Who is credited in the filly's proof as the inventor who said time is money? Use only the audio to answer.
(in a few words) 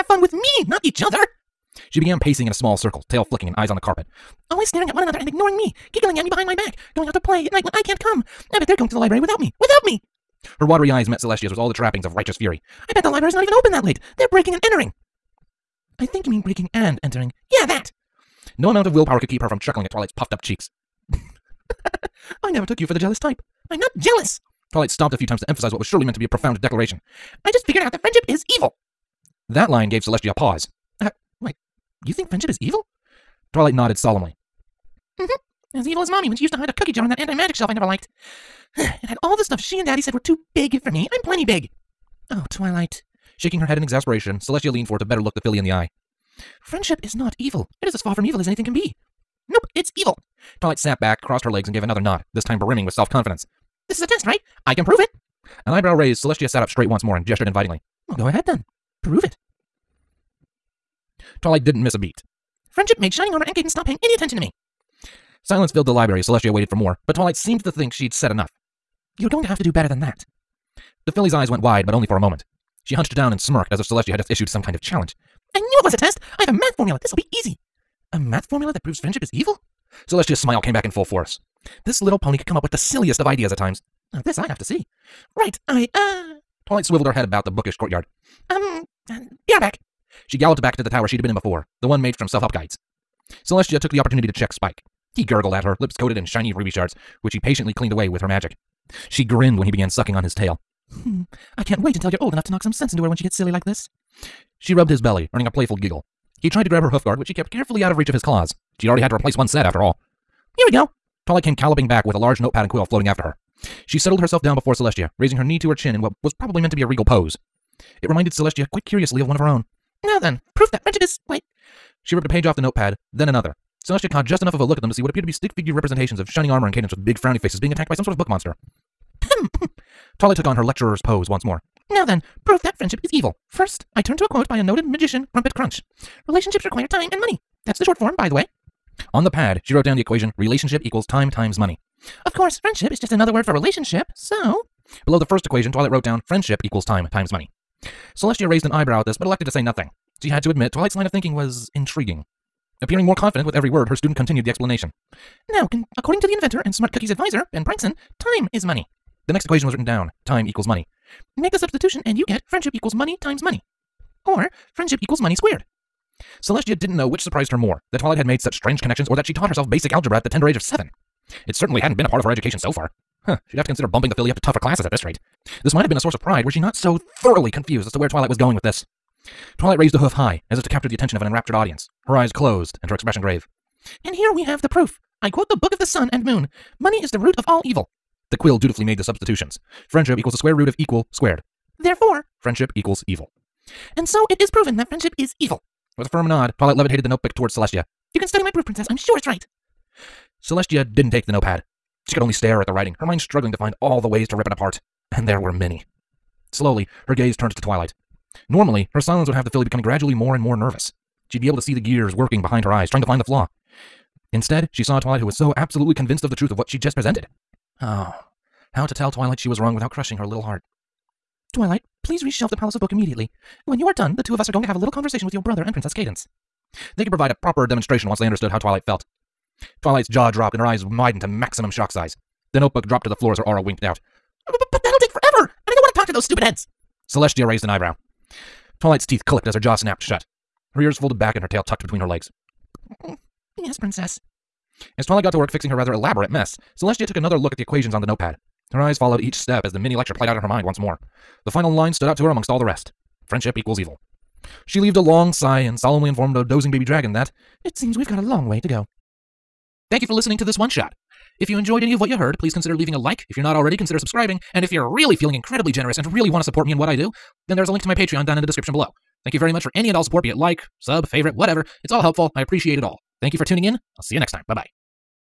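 Ben Prankson.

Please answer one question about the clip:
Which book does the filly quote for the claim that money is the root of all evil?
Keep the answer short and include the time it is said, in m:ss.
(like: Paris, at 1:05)
The Book of the Sun and Moon, at 3:05.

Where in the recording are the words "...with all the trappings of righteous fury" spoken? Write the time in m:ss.
0:11.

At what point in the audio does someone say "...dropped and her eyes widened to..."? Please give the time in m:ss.
3:50.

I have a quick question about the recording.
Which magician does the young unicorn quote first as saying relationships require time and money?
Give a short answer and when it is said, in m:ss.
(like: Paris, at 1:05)
Crumpet Crunch, at 2:15.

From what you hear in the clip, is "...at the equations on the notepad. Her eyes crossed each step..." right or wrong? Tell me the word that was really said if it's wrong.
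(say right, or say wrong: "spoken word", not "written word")
wrong: "followed", not "crossed".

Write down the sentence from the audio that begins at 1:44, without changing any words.
She rubbed his belly, earning a playful giggle.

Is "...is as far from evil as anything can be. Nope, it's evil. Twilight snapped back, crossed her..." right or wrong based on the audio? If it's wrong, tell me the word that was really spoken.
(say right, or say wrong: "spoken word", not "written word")
right.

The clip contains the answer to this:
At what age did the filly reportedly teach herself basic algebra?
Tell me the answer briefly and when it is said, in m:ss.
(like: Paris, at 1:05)
7, at 2:50.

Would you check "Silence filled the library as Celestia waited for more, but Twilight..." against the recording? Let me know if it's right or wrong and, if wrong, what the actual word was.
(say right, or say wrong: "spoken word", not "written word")
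right.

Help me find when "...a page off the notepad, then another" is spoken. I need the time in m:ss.
2:02.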